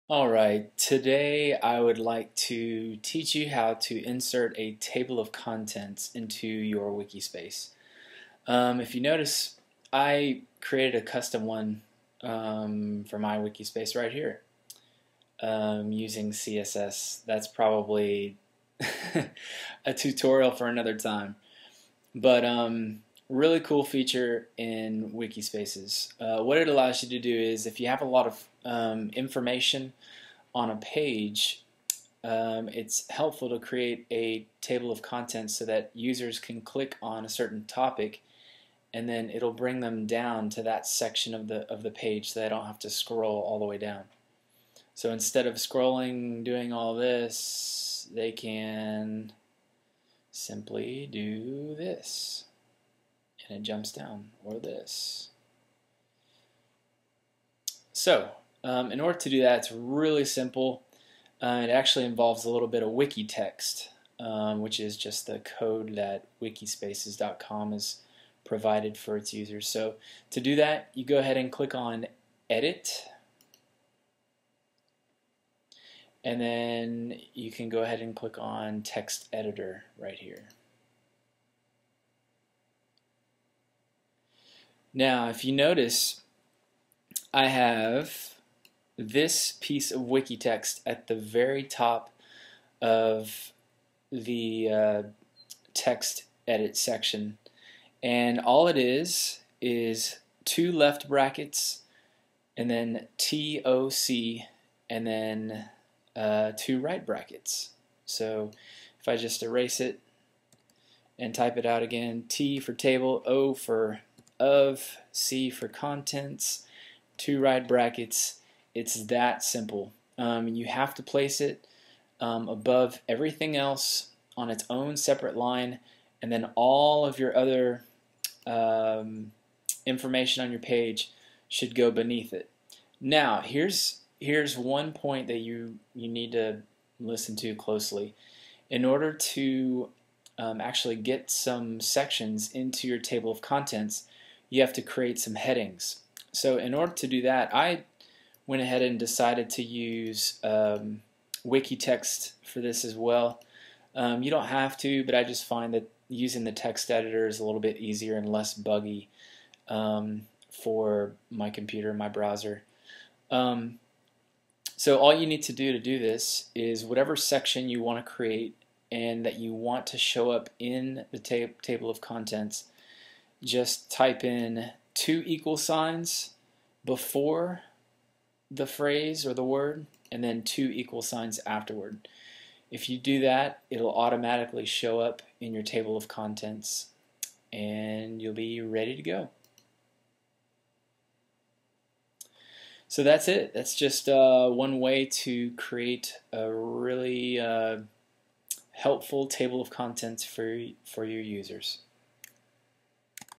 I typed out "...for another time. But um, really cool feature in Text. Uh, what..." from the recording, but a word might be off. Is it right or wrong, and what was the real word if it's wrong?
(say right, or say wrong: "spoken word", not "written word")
wrong: "Wikispaces", not "Text".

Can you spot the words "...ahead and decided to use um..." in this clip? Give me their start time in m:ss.
2:28.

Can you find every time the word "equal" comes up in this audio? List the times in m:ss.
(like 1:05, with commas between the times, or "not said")
2:55, 3:00.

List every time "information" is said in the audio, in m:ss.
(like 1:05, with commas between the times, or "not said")
0:29, 2:09.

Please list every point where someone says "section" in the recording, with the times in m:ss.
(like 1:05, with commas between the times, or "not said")
0:40, 1:36, 2:21, 2:47.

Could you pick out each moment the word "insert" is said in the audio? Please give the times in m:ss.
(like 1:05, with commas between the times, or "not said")
0:04.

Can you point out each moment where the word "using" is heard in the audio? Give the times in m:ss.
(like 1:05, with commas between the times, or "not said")
0:15, 2:36.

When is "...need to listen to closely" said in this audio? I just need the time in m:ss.
2:16.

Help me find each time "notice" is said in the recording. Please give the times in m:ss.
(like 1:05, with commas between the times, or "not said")
0:08, 1:25.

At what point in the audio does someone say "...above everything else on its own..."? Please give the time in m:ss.
2:02.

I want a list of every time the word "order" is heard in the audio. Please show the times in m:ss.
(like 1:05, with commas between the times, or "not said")
0:59, 2:18, 2:26.